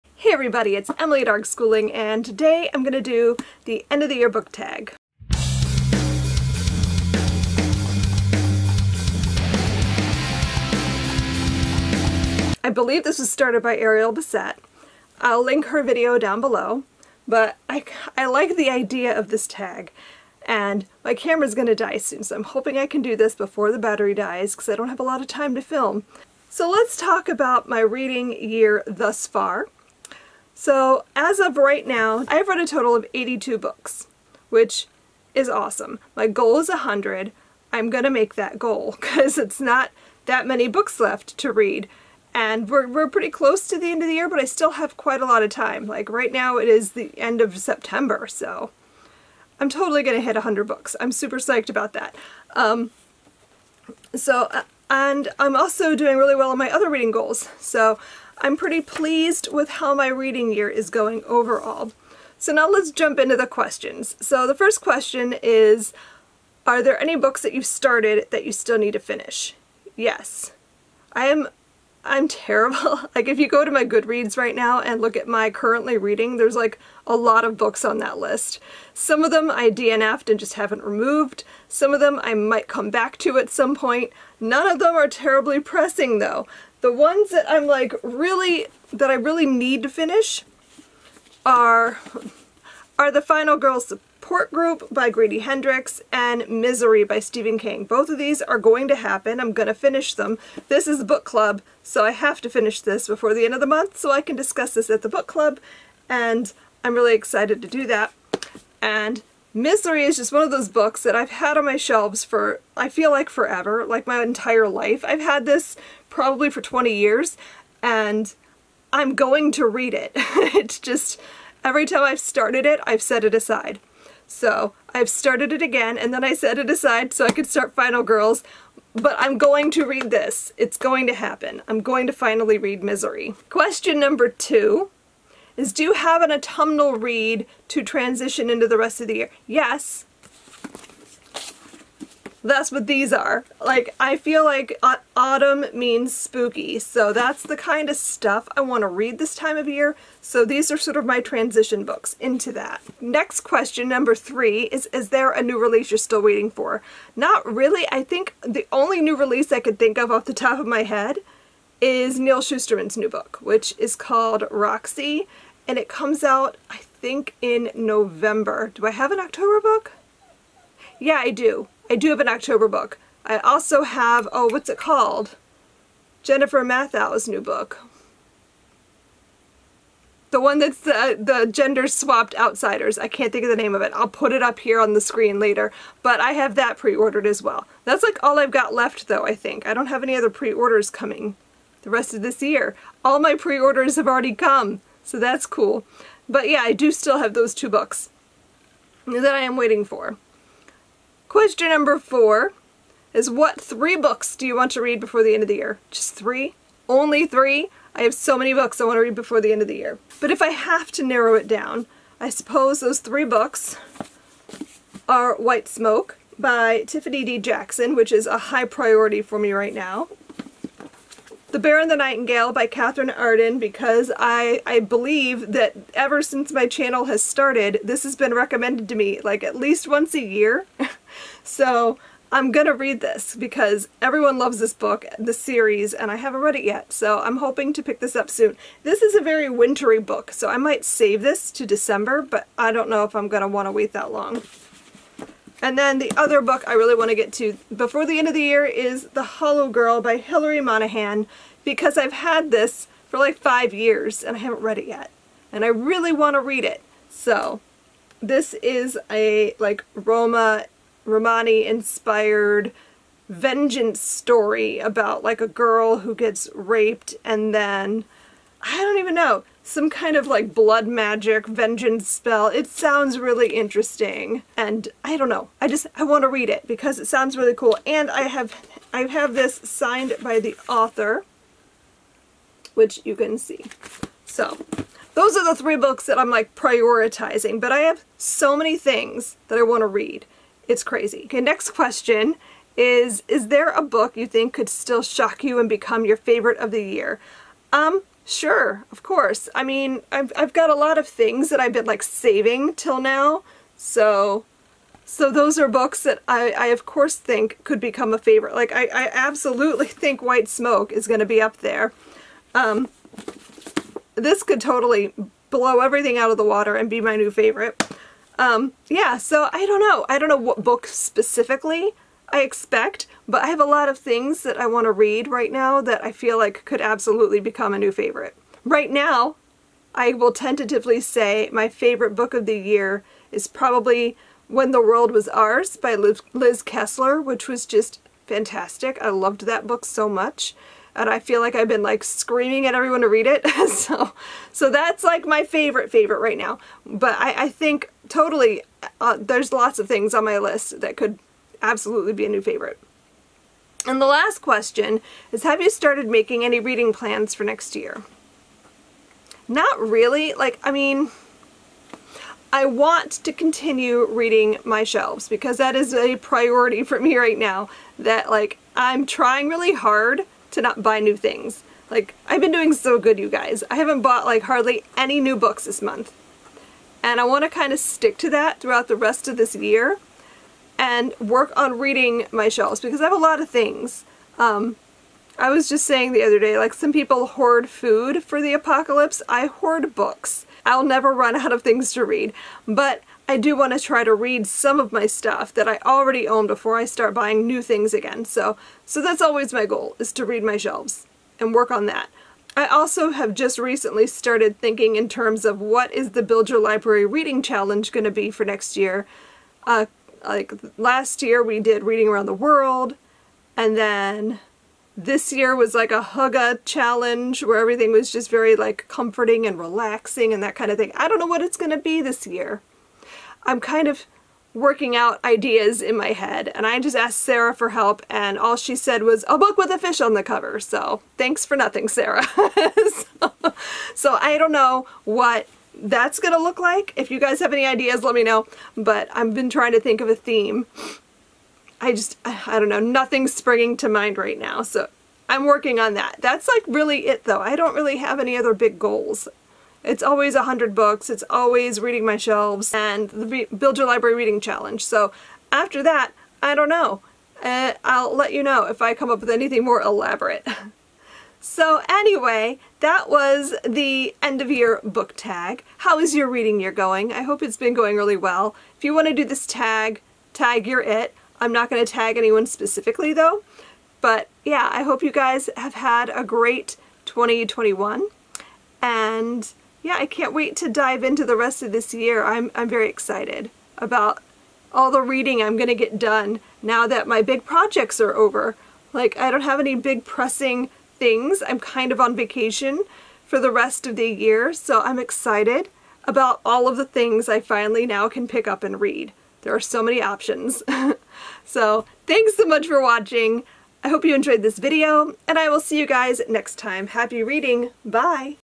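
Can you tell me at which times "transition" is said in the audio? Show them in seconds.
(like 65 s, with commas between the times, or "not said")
137 s, 151 s.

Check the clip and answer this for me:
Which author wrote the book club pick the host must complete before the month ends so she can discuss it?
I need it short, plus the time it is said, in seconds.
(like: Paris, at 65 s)
Grady Hendrix, at 95 s.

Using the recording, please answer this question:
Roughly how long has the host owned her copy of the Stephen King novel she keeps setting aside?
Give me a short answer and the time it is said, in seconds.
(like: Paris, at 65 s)
20 years, at 116 s.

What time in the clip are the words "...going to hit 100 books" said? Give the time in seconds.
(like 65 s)
50 s.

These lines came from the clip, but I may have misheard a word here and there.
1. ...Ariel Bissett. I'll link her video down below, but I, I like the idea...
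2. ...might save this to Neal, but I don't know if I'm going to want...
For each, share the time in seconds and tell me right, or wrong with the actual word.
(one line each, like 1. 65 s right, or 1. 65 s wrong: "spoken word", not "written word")
1. 13 s right
2. 240 s wrong: "December", not "Neal".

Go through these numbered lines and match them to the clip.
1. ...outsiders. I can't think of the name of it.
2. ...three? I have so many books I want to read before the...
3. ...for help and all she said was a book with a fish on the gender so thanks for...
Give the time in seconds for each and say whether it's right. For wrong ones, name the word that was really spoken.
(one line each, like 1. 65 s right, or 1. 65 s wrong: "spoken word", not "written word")
1. 182 s right
2. 207 s right
3. 427 s wrong: "cover", not "gender".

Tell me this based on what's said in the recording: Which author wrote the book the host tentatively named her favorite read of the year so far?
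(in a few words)
Liz Kessler.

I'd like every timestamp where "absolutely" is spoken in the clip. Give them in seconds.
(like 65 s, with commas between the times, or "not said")
309 s, 326 s, 351 s.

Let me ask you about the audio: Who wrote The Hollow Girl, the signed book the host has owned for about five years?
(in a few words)
Hillary Monahan.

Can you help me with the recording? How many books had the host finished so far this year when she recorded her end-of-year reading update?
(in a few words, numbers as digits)
82.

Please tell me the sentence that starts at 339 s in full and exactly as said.
I loved that book so much and I feel like I've been like screaming at everyone to read it.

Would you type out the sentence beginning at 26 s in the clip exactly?
So let's talk about my reading year thus far.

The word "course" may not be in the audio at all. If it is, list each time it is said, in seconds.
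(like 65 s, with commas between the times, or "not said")
299 s, 306 s.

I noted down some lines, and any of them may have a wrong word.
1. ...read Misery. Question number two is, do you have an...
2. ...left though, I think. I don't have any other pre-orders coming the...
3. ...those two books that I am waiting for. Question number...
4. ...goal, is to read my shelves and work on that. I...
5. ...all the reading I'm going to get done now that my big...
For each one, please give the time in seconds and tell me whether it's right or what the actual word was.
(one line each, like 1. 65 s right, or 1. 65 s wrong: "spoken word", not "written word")
1. 132 s right
2. 188 s right
3. 197 s right
4. 399 s right
5. 484 s right.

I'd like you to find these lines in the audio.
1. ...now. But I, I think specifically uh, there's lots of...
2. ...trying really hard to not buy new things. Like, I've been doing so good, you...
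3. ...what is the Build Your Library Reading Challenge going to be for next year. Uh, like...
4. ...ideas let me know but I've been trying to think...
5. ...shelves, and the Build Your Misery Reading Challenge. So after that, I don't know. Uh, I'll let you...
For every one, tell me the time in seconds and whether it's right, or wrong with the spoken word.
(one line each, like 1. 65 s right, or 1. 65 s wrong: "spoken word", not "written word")
1. 346 s wrong: "totally", not "specifically"
2. 369 s right
3. 405 s right
4. 437 s right
5. 452 s wrong: "Library", not "Misery".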